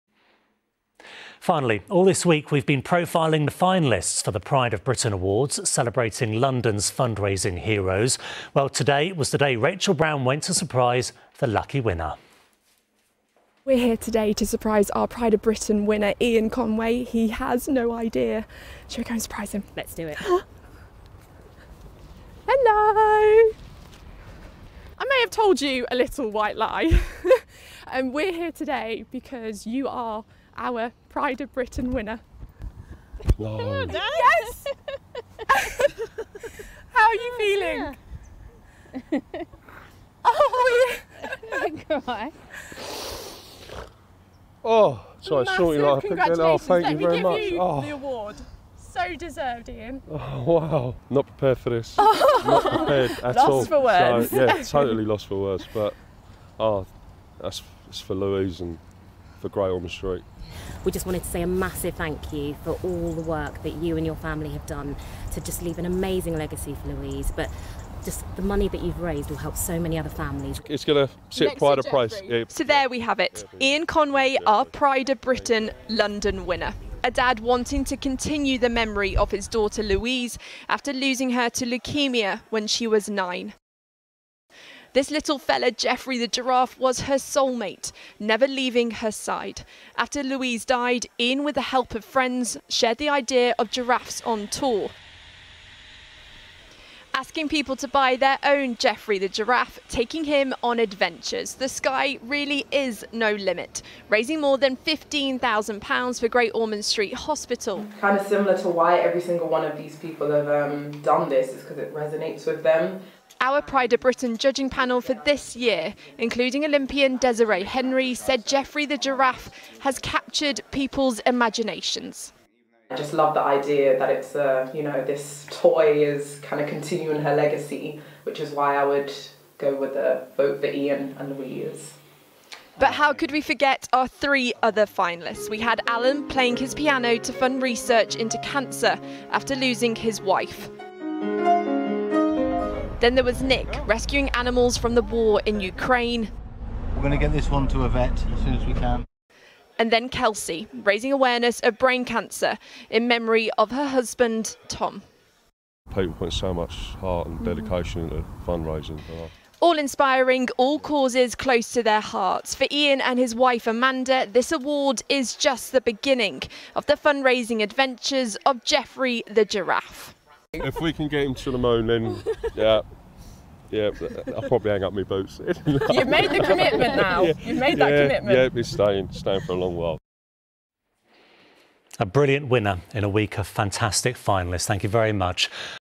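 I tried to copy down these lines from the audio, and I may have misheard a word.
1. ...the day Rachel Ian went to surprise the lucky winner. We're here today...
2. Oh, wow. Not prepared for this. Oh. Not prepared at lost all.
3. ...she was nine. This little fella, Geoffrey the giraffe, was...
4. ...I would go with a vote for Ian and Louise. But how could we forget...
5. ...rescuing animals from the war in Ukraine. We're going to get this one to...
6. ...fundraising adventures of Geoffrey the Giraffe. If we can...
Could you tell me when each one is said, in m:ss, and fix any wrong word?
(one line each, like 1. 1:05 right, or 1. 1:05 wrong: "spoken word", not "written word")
1. 0:09 wrong: "Brown", not "Ian"
2. 0:50 right
3. 1:22 right
4. 2:08 right
5. 2:23 right
6. 2:46 right.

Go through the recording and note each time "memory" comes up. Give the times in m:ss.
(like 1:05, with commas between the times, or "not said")
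1:18, 2:33.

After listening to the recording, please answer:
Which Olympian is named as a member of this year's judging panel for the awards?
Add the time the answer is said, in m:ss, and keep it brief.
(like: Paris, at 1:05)
Desiree Henry, at 1:57.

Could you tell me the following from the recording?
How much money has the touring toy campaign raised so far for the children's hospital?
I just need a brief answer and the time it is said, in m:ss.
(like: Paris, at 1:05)
More than £15,000, at 1:44.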